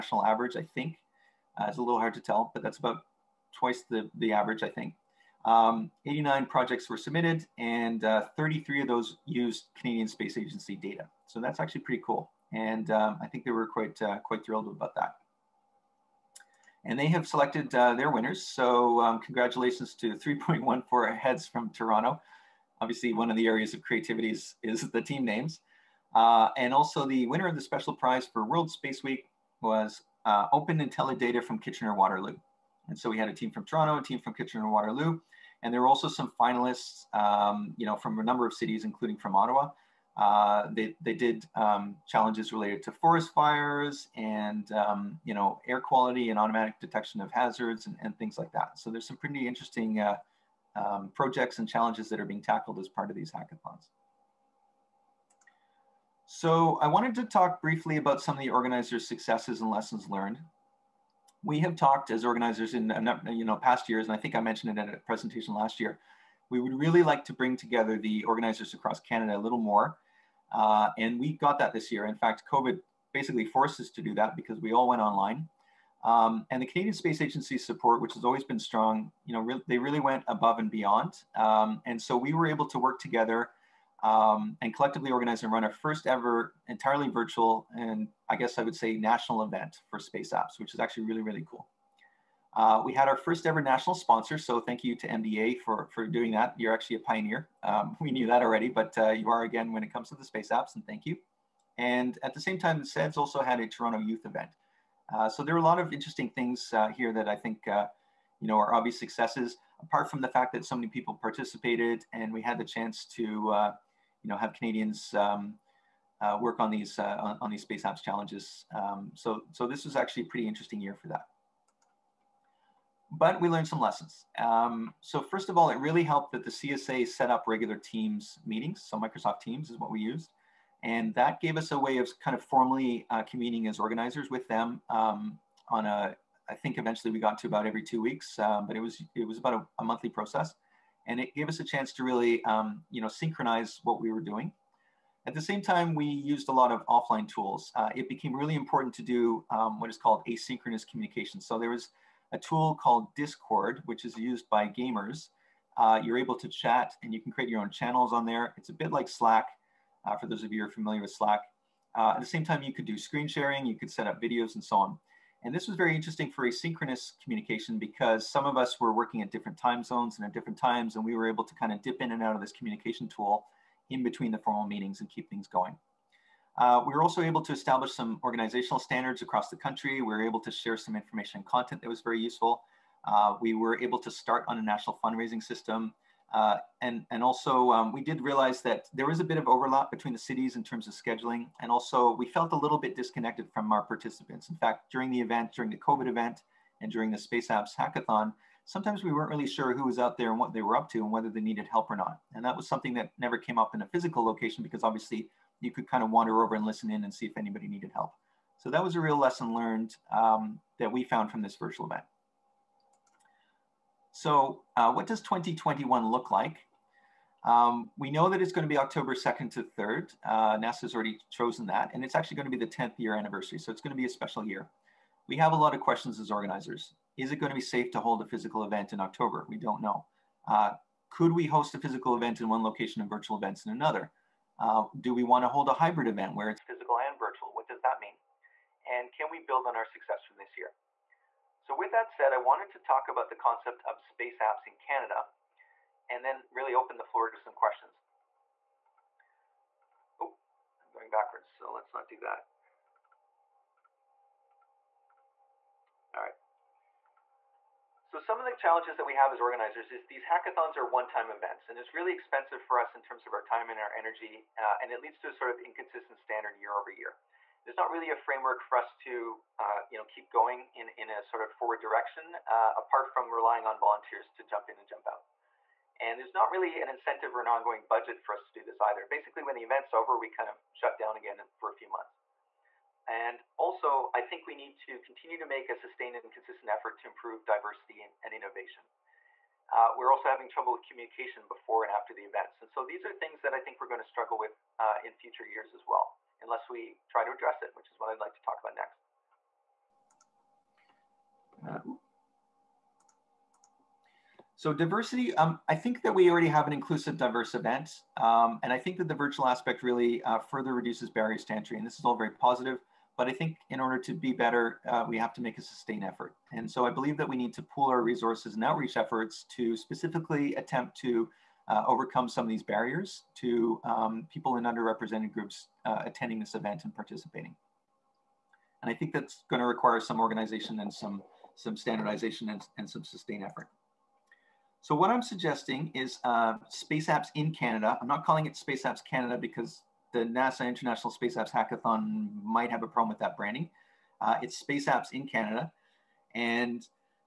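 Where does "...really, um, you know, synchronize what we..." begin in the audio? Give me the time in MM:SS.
02:22.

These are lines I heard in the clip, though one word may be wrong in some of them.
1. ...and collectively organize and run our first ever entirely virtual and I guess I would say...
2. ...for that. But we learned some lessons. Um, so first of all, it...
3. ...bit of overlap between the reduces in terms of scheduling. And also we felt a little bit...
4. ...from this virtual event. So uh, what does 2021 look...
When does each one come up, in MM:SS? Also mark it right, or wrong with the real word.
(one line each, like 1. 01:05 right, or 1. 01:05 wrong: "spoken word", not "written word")
1. 01:24 right
2. 02:00 right
3. 03:09 wrong: "cities", not "reduces"
4. 03:31 right.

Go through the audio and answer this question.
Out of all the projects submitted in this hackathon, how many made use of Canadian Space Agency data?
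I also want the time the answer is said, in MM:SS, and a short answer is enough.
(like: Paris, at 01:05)
33, at 00:08.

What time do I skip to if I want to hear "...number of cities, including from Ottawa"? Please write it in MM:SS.
00:38.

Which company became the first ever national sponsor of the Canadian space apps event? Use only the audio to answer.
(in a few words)
MDA.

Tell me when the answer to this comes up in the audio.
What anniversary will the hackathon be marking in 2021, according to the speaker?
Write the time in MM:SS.
03:42.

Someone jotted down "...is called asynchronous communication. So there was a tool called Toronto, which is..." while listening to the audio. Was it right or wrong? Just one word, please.
wrong.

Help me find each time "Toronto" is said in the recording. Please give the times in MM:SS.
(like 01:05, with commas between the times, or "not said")
00:21, 00:33, 01:43.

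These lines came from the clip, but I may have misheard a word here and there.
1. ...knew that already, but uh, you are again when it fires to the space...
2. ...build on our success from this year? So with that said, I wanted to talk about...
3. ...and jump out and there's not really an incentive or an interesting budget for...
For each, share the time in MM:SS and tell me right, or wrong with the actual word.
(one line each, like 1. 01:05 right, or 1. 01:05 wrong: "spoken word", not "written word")
1. 01:38 wrong: "comes", not "fires"
2. 03:59 right
3. 04:34 wrong: "ongoing", not "interesting".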